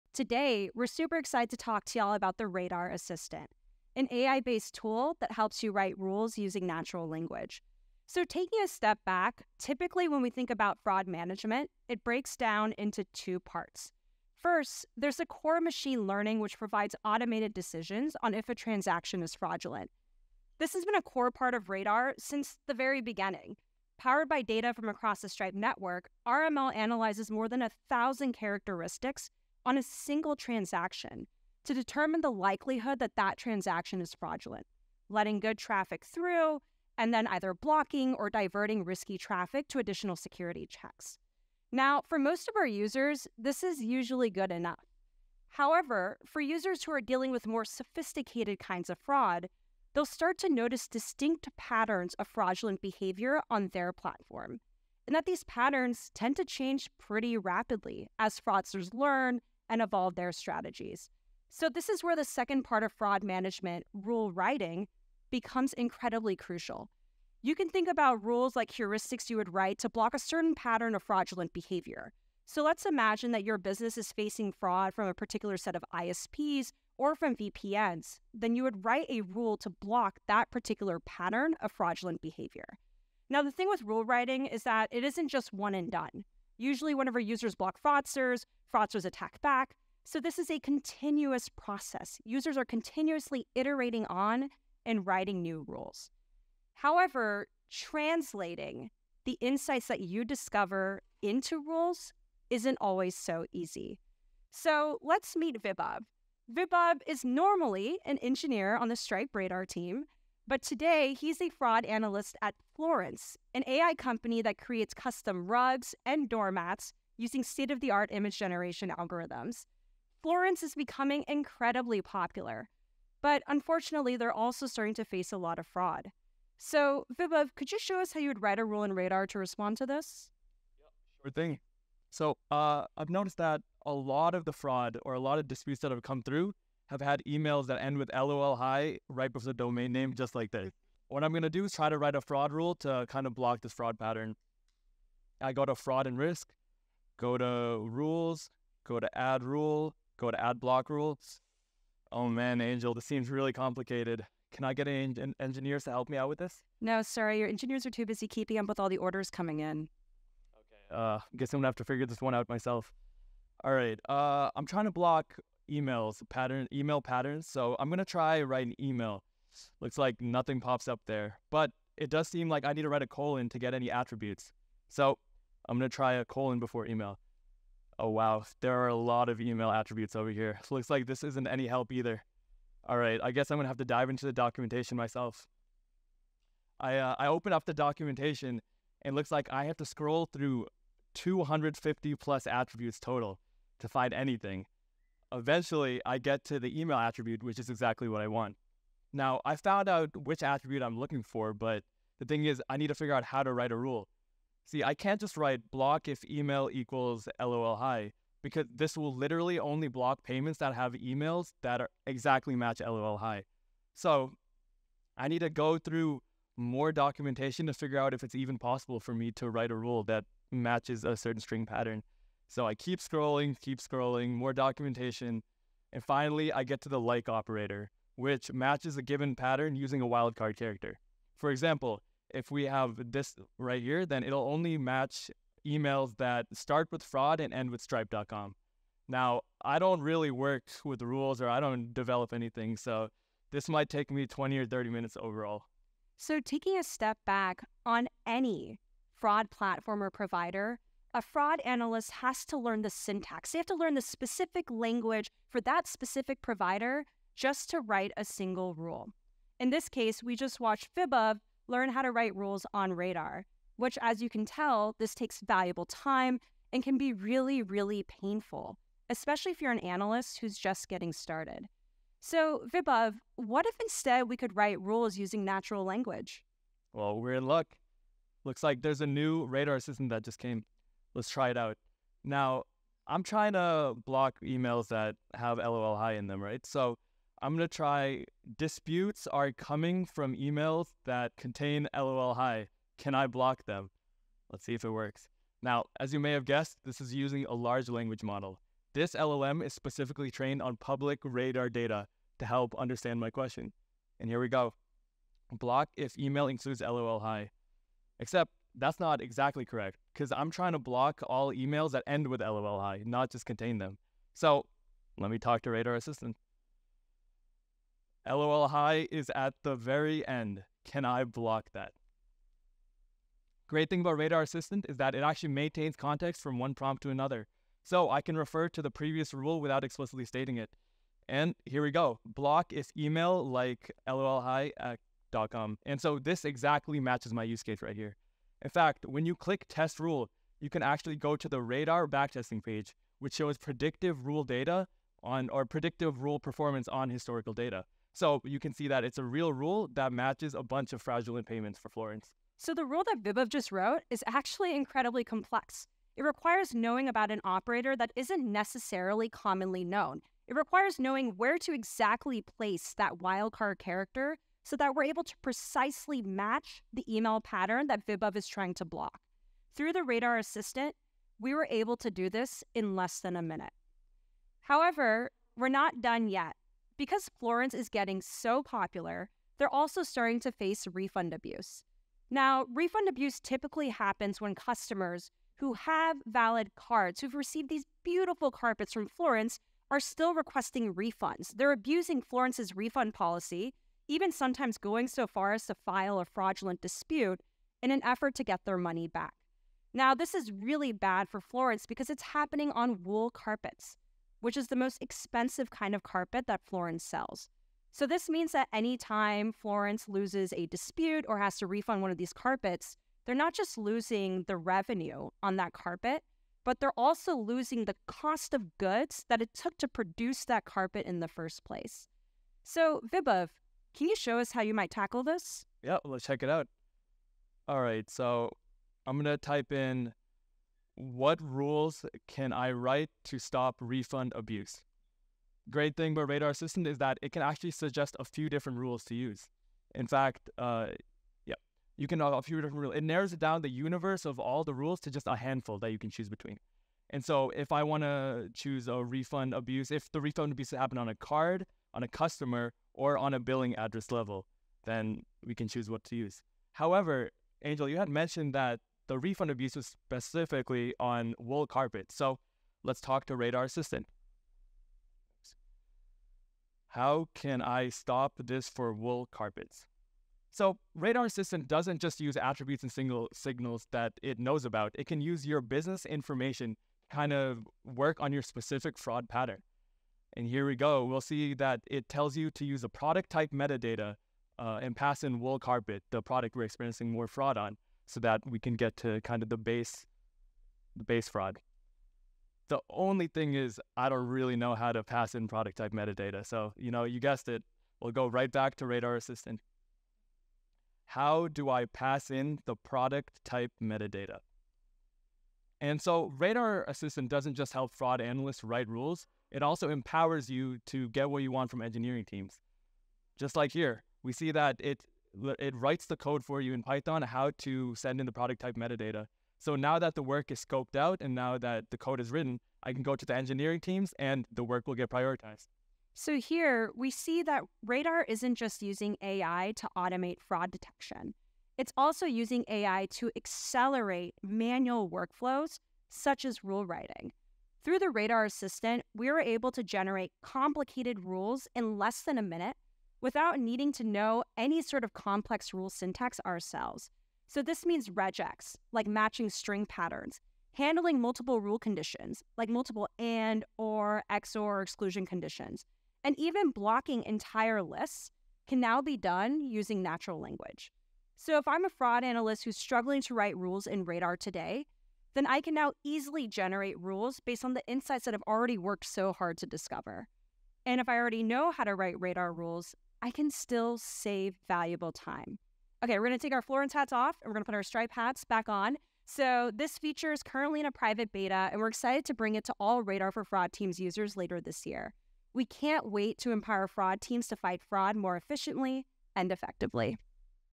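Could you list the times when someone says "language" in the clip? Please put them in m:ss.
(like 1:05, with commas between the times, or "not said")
0:07, 4:14, 4:35, 4:57, 9:20.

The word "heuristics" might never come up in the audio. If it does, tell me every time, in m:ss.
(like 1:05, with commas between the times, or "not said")
1:08.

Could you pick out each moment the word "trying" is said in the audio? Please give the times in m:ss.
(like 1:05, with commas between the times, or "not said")
2:44, 4:43, 5:10, 6:08.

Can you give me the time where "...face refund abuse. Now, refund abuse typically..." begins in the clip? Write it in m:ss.
6:20.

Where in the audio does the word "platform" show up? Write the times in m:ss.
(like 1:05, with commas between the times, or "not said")
0:53, 4:09.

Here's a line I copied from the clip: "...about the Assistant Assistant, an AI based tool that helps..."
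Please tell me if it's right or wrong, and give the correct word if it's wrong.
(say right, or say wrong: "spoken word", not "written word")
wrong: "Radar", not "Assistant".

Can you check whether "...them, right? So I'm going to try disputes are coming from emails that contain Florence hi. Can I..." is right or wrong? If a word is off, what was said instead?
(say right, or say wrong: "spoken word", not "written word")
wrong: "LOL", not "Florence".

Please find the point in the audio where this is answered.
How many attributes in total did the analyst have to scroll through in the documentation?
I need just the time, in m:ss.
3:11.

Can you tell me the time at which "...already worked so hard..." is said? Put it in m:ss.
9:28.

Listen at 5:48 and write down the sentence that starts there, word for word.
So you can see that it's a real rule that matches a bunch of fraudulent payments for Florence.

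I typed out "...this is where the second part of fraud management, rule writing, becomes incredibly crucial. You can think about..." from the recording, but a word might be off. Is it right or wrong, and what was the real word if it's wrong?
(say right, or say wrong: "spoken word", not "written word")
right.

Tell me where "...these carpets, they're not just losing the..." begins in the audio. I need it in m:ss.
6:52.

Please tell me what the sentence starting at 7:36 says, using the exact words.
However, Angel, you had mentioned that the refund abuse was specifically on wool carpet.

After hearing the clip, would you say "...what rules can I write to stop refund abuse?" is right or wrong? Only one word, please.
right.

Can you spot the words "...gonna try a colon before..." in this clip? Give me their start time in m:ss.
2:55.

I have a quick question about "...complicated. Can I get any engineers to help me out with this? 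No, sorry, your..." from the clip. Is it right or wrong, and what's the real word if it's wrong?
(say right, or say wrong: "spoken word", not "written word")
right.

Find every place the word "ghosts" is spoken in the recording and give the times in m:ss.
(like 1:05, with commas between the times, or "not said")
not said.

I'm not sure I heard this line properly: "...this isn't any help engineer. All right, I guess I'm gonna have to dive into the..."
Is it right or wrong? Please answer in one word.
wrong.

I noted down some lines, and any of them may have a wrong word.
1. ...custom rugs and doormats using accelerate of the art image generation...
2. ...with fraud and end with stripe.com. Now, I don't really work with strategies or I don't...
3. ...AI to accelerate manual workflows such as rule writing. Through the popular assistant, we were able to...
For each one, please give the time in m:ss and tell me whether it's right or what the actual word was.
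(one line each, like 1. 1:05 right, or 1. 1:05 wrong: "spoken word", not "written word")
1. 1:54 wrong: "state", not "accelerate"
2. 3:56 wrong: "rules", not "strategies"
3. 8:52 wrong: "radar", not "popular".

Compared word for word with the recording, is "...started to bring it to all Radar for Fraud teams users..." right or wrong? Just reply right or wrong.
wrong.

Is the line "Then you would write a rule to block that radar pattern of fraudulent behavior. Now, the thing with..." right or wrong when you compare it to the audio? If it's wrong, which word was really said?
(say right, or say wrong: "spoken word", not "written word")
wrong: "particular", not "radar".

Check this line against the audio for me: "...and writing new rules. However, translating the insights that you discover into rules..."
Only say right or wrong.
right.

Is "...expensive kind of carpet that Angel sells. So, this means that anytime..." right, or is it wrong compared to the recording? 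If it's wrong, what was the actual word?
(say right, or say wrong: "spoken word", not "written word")
wrong: "Florence", not "Angel".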